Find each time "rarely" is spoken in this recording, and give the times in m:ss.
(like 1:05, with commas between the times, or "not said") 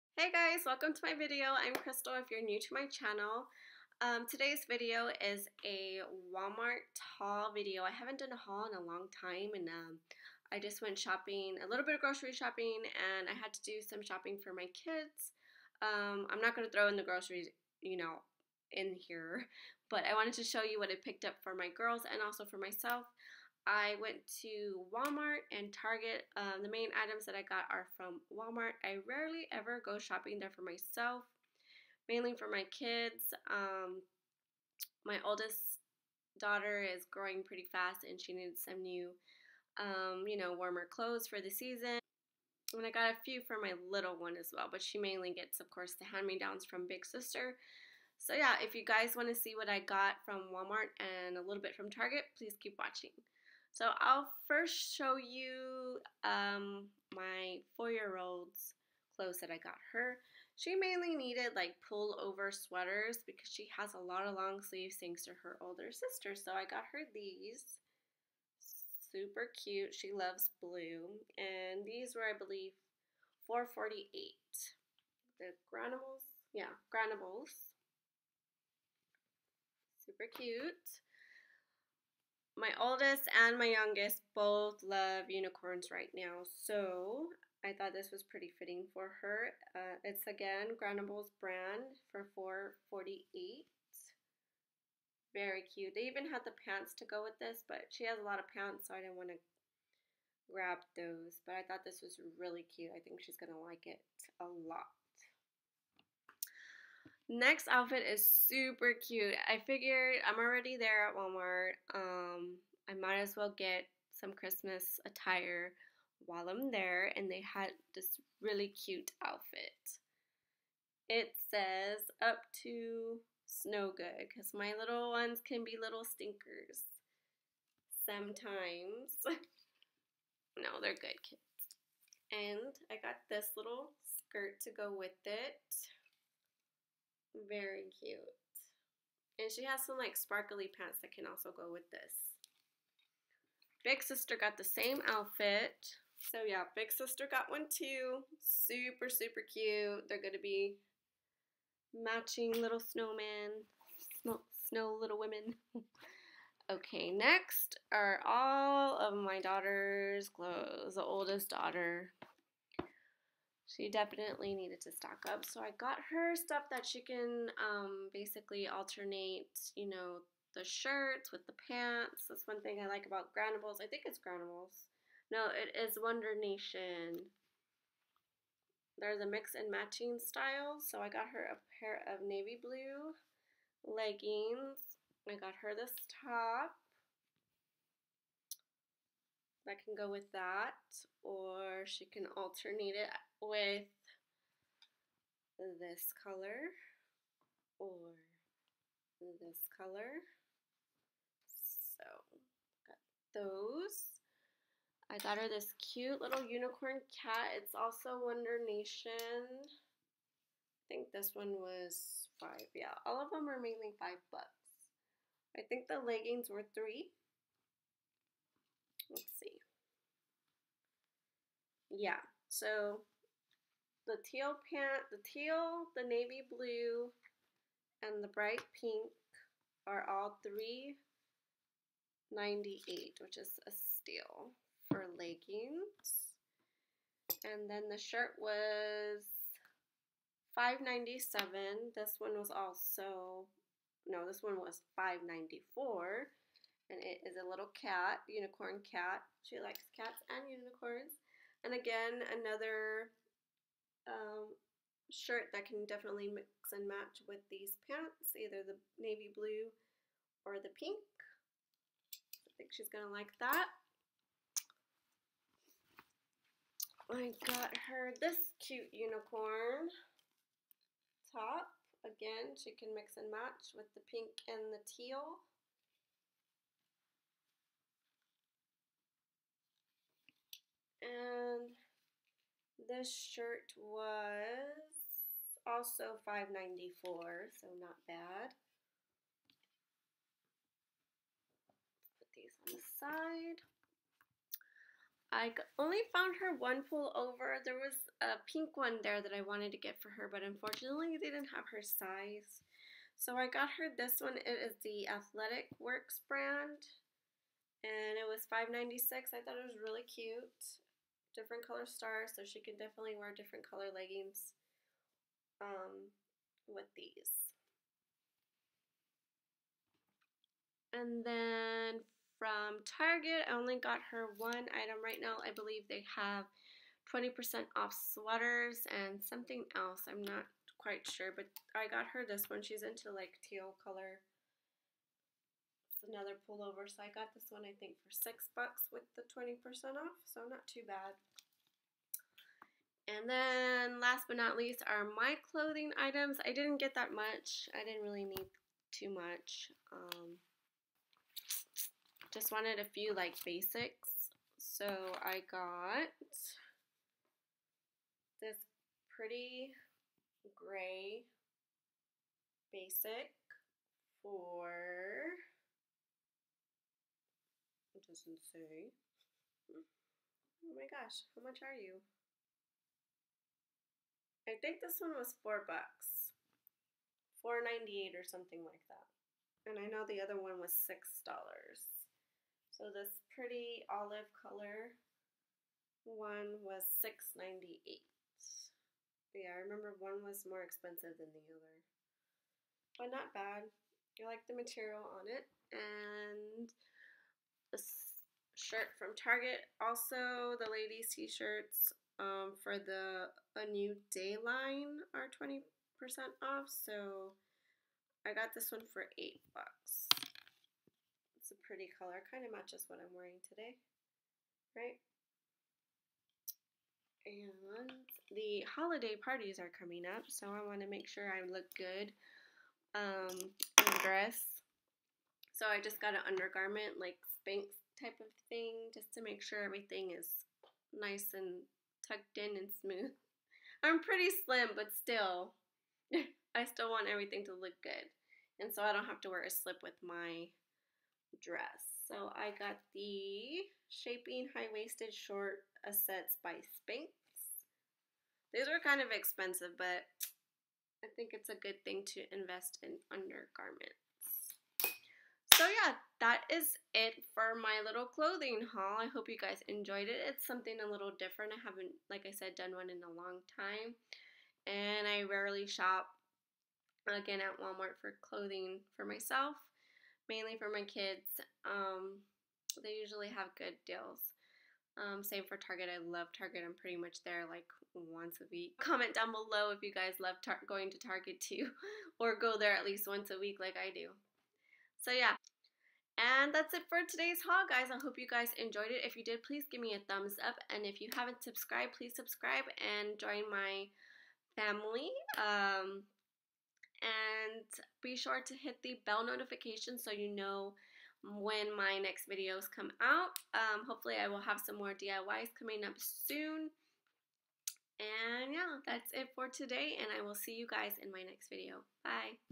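0:29, 7:45.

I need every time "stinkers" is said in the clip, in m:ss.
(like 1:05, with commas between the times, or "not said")
2:06.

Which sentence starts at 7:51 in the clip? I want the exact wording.
Um, they usually have good deals.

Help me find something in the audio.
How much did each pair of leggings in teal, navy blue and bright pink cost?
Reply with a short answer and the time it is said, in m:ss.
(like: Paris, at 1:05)
$3.98, at 3:50.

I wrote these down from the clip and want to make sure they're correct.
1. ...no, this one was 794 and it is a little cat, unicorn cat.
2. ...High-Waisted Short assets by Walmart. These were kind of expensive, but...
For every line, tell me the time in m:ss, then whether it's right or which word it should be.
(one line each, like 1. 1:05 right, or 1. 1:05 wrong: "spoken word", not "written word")
1. 4:04 wrong: "594", not "794"
2. 7:24 wrong: "Spanx", not "Walmart".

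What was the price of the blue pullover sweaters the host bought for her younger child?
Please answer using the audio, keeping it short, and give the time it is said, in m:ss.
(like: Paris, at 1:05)
$4.48, at 1:13.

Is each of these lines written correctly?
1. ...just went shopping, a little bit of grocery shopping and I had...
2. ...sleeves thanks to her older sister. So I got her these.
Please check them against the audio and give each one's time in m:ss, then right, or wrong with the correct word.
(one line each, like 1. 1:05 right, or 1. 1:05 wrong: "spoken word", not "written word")
1. 0:10 right
2. 1:04 right.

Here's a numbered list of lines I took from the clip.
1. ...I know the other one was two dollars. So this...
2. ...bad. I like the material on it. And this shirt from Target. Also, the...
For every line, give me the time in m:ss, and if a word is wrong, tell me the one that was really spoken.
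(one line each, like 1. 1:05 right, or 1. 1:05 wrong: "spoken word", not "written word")
1. 6:19 wrong: "six", not "two"
2. 6:33 right.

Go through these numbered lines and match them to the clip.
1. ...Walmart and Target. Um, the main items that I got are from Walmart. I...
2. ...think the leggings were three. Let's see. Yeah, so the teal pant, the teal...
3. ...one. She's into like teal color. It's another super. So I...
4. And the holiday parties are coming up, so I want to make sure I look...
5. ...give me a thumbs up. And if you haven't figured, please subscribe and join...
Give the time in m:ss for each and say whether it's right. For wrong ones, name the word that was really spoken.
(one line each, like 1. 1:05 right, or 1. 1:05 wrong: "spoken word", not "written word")
1. 0:24 right
2. 3:35 right
3. 5:32 wrong: "pullover", not "super"
4. 6:57 right
5. 8:09 wrong: "subscribed", not "figured".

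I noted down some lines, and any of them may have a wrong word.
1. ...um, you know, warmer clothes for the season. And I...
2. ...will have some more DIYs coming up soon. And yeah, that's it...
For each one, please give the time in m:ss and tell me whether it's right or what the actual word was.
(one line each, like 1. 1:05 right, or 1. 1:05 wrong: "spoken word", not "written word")
1. 0:39 right
2. 8:24 right.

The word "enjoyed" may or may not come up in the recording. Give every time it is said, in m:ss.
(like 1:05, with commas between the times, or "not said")
7:39, 8:08.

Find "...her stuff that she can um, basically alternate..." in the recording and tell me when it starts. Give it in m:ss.
2:46.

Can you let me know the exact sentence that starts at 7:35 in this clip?
So yeah, that is it for my little clothing haul.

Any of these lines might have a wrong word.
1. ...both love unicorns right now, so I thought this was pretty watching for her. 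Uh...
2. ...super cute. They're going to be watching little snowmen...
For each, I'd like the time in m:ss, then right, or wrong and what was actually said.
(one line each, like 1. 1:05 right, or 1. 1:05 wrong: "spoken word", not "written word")
1. 1:24 wrong: "fitting", not "watching"
2. 2:29 wrong: "matching", not "watching".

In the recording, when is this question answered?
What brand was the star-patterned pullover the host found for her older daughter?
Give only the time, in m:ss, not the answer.
5:05.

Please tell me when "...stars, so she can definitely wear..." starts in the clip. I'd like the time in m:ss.
5:11.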